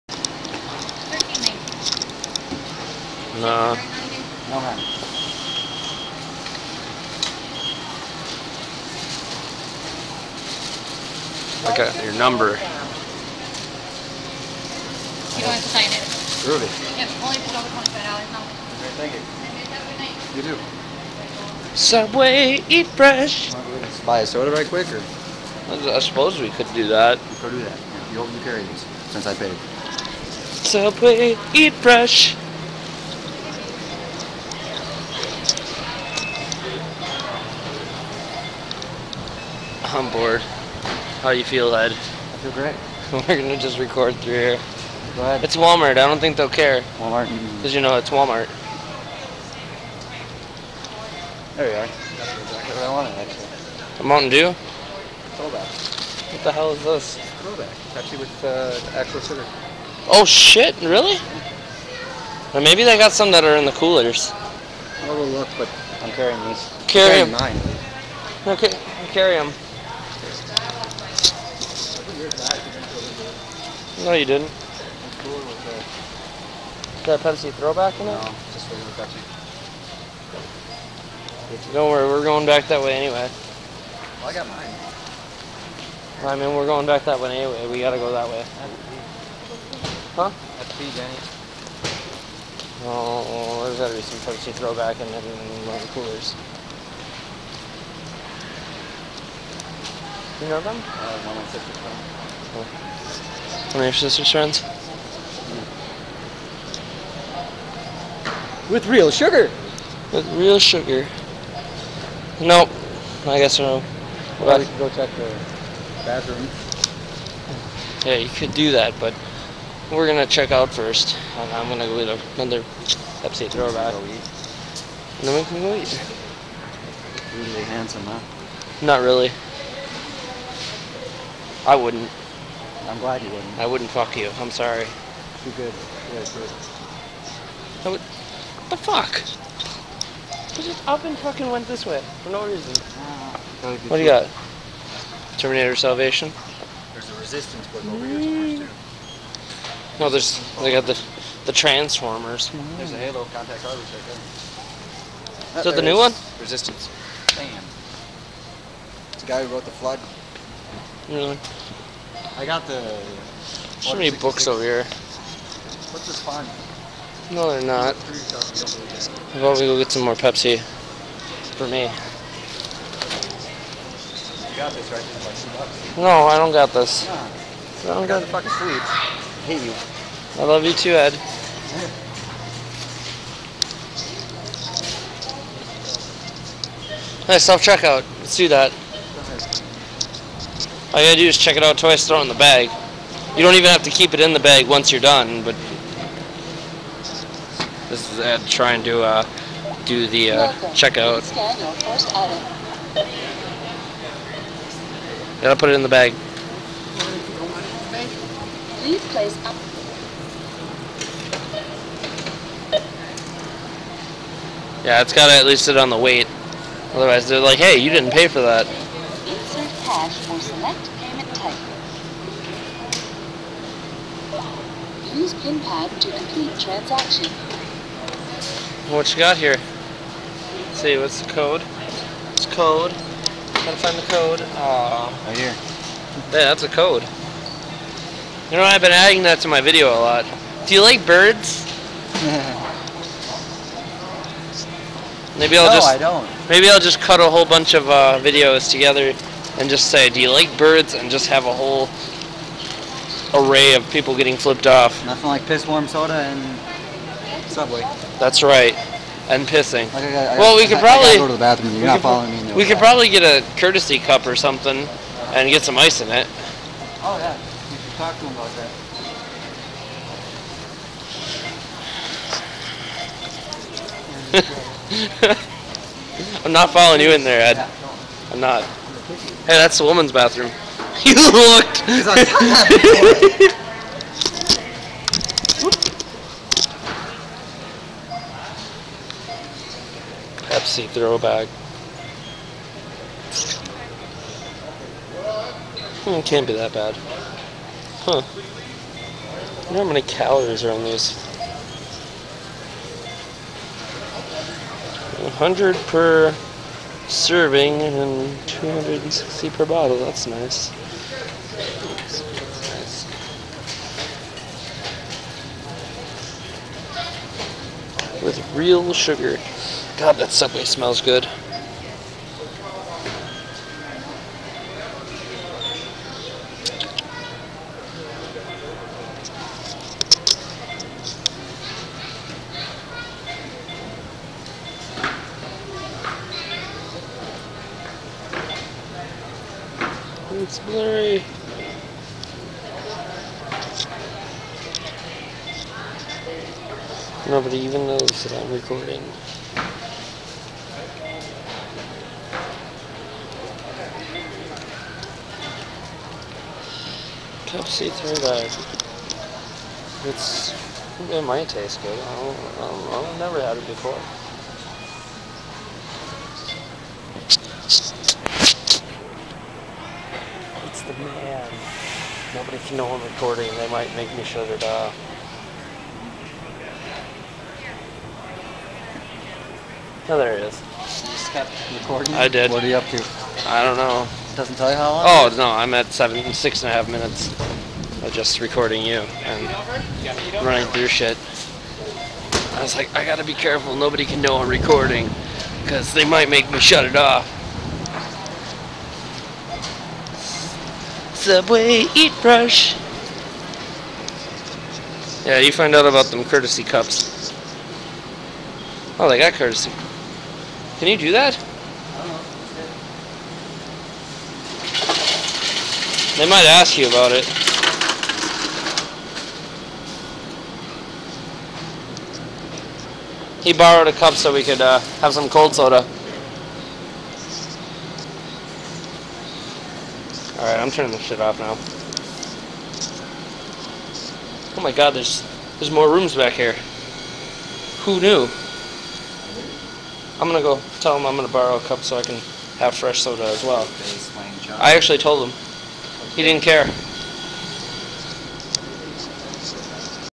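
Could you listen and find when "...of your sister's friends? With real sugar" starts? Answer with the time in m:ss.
1:43.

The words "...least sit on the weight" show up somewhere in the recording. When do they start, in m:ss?
3:35.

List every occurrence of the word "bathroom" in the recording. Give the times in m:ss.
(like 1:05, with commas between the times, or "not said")
1:56, 4:21, 4:40.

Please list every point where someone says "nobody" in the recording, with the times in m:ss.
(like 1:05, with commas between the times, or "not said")
5:47, 6:12, 6:33.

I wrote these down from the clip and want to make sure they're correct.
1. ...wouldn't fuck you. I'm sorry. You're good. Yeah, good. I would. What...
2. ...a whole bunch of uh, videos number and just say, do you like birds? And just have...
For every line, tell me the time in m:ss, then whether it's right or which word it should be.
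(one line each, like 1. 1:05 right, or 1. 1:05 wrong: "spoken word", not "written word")
1. 2:13 right
2. 4:07 wrong: "together", not "number".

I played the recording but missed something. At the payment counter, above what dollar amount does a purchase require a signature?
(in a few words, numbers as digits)
$25.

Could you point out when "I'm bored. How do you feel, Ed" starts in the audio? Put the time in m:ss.
0:39.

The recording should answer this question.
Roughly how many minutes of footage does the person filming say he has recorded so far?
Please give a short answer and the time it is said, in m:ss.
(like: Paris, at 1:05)
6.5 minutes, at 6:26.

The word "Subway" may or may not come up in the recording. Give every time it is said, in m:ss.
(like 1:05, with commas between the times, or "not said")
0:21, 0:30, 4:17, 5:20, 6:41.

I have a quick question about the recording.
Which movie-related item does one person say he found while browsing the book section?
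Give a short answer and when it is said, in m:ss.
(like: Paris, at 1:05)
Terminator Salvation, at 2:25.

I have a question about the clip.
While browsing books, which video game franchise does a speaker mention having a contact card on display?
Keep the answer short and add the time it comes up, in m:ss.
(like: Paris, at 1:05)
Halo, at 2:32.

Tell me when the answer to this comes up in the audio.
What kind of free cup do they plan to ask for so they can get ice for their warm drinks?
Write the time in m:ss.
4:23.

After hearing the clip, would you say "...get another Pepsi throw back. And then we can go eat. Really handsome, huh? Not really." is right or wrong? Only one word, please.
right.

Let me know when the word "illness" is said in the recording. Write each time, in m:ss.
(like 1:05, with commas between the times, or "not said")
not said.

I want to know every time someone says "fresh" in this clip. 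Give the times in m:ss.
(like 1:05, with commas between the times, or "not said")
0:22, 0:31, 7:22.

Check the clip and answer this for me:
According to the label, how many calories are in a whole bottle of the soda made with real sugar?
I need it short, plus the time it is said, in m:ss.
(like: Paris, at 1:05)
260, at 5:08.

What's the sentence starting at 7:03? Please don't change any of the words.
He borrowed a cup so we could uh, have some cold soda.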